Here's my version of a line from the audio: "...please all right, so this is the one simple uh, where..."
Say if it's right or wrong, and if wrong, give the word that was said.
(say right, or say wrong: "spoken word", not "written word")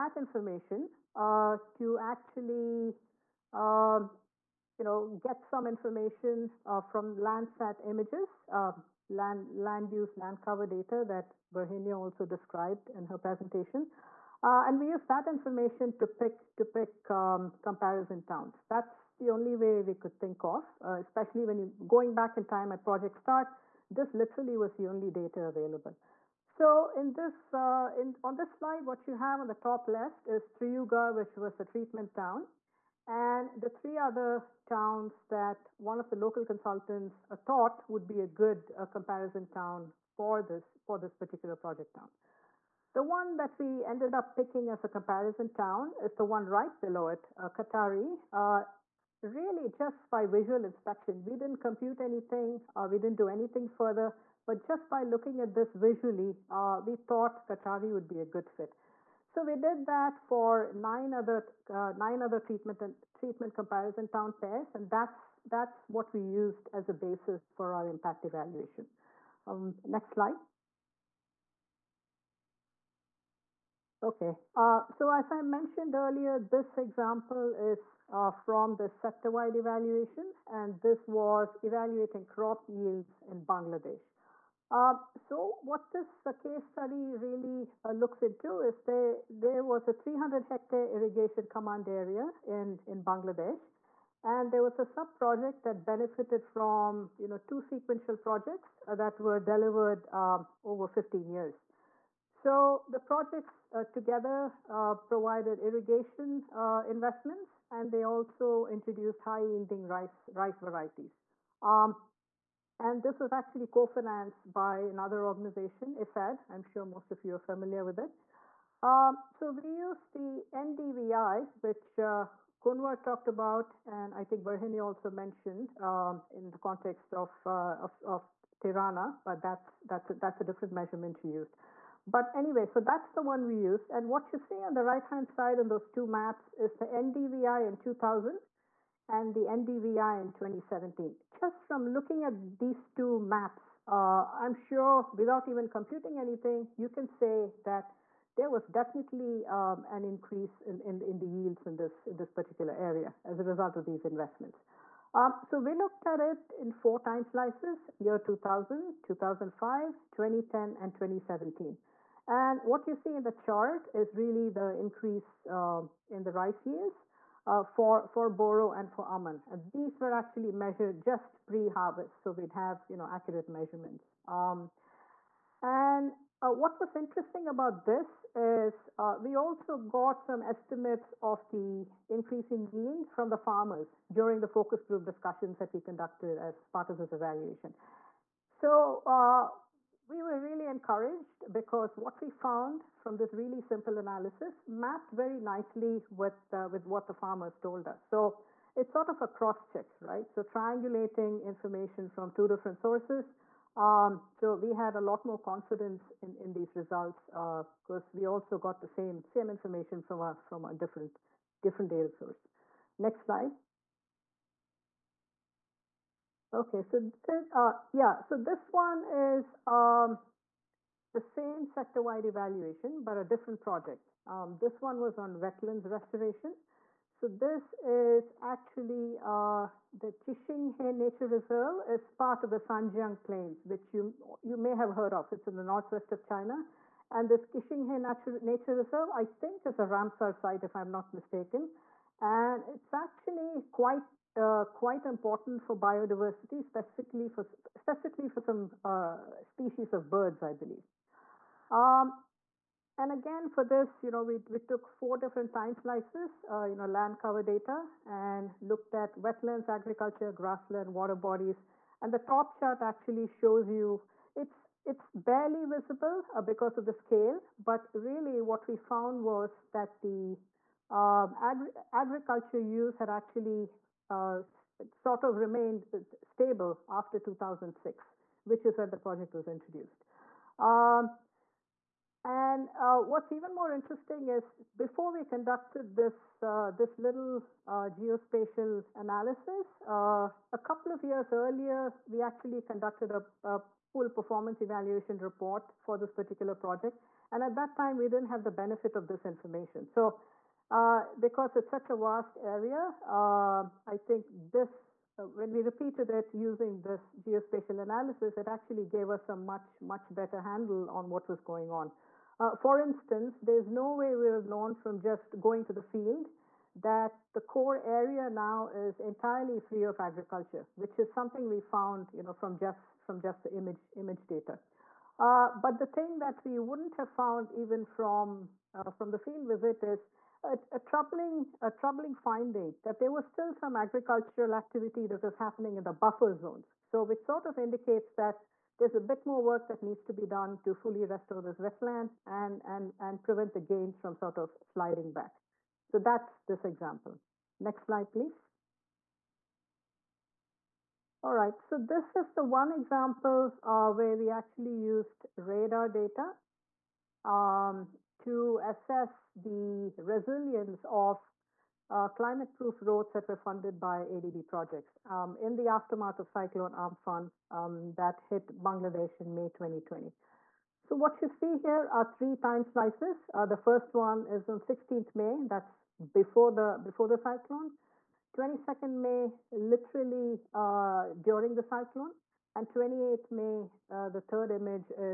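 wrong: "example", not "simple".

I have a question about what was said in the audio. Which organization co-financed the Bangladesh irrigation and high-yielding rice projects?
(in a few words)
IFAD.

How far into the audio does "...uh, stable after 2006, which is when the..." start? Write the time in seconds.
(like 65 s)
275 s.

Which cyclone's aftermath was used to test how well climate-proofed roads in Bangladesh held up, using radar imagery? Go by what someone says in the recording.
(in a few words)
Cyclone Amphan.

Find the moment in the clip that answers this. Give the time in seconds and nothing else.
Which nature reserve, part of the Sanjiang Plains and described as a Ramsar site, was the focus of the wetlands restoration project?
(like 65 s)
230 s.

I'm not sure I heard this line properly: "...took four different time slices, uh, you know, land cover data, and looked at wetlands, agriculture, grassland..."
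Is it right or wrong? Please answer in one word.
right.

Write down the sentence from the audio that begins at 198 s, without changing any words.
So it's sort of a cross check, right?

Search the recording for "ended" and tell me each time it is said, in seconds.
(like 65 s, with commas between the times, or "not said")
43 s.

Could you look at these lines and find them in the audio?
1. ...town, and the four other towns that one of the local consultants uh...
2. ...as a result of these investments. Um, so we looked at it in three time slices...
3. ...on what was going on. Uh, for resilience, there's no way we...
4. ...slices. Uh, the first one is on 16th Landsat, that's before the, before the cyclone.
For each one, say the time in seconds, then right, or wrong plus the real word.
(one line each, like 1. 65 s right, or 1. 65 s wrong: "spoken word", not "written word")
1. 32 s wrong: "three", not "four"
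2. 153 s wrong: "four", not "three"
3. 310 s wrong: "instance", not "resilience"
4. 372 s wrong: "May", not "Landsat".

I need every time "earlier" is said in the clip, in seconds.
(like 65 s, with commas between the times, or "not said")
75 s, 291 s.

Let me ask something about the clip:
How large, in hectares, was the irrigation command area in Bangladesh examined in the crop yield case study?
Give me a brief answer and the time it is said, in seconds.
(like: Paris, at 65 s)
300 hectares, at 89 s.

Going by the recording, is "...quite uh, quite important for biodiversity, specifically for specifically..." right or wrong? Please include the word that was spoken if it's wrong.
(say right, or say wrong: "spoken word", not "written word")
right.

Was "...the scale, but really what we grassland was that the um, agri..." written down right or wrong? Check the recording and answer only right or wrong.
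wrong.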